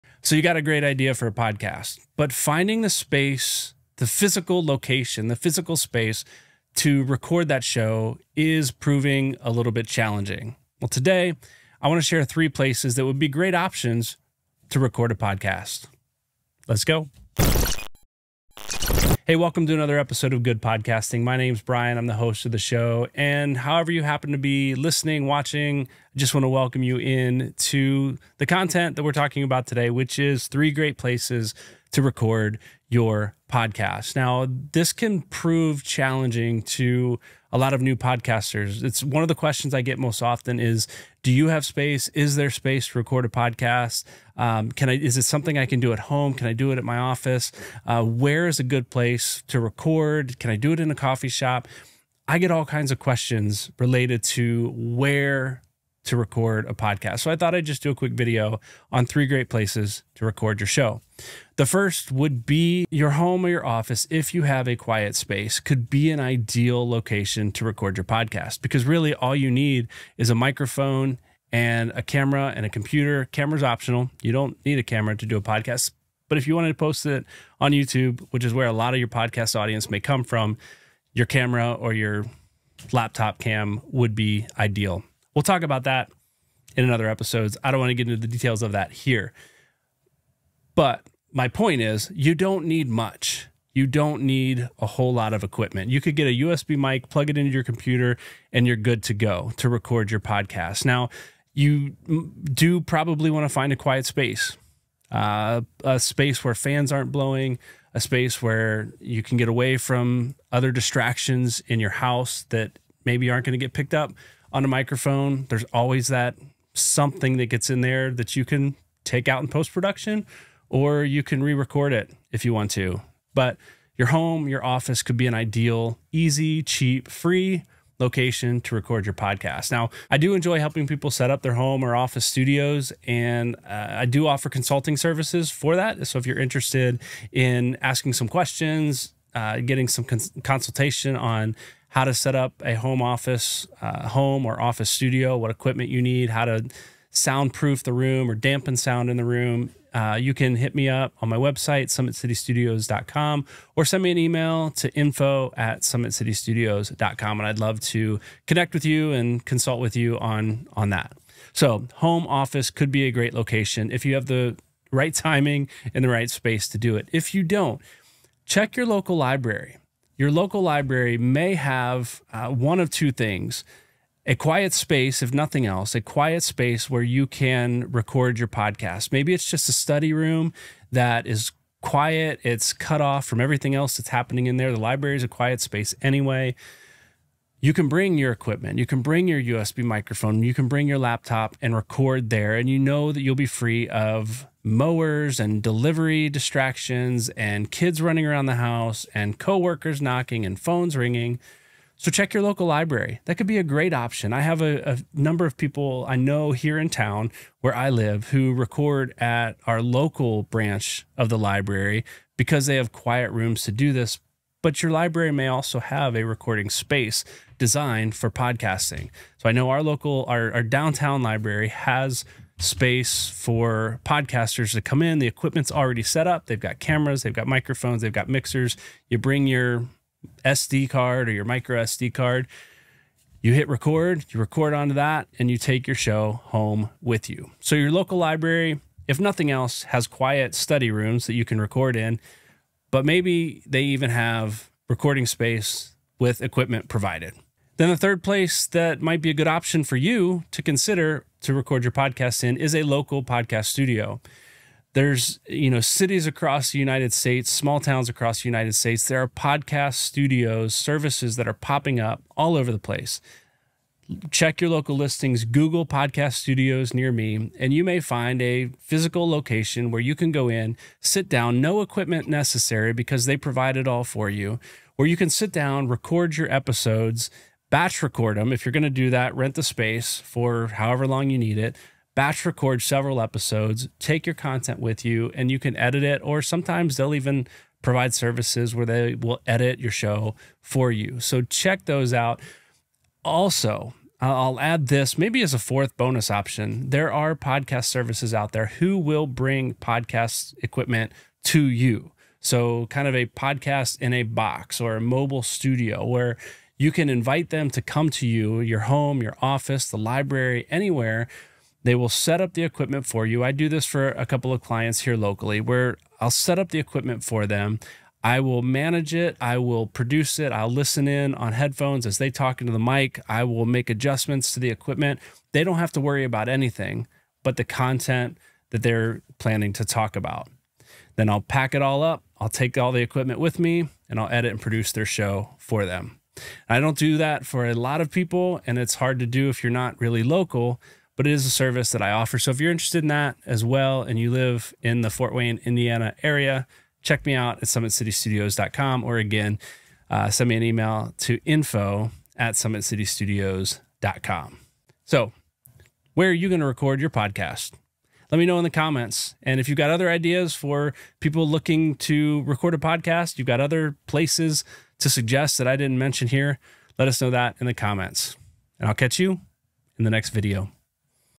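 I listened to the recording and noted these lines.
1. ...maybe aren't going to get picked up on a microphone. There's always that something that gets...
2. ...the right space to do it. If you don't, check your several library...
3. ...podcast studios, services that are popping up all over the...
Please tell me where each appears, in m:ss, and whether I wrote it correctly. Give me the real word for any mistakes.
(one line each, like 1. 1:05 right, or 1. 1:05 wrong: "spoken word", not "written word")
1. 1:53 right
2. 2:46 wrong: "local", not "several"
3. 4:19 right.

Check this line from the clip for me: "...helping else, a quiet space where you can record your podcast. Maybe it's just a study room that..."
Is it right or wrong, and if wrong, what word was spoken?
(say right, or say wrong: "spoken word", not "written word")
wrong: "nothing", not "helping".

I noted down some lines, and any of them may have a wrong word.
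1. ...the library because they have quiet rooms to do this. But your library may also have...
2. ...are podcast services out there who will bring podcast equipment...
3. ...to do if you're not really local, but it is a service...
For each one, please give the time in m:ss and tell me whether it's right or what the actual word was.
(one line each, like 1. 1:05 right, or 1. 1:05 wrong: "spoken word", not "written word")
1. 3:31 right
2. 4:57 right
3. 5:39 right.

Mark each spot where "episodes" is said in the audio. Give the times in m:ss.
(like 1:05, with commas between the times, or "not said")
0:19, 1:27, 4:36, 4:43.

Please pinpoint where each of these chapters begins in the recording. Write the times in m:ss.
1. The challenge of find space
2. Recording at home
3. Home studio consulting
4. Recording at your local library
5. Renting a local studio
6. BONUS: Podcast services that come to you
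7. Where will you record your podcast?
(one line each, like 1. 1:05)
1. 0:33
2. 1:01
3. 2:10
4. 2:48
5. 4:07
6. 4:52
7. 5:55.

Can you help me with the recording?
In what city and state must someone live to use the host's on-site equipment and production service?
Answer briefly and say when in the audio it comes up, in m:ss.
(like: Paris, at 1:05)
Fort Wayne, Indiana, at 5:45.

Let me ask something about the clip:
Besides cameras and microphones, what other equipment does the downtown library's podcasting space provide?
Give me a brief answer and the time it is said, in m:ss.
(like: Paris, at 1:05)
Mixers, at 3:48.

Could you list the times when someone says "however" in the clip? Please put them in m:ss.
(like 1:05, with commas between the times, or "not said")
0:23, 4:40.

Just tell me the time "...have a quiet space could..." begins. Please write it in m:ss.
1:04.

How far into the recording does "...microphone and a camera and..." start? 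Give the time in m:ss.
1:10.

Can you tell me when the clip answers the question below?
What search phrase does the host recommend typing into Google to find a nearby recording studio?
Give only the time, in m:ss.
4:25.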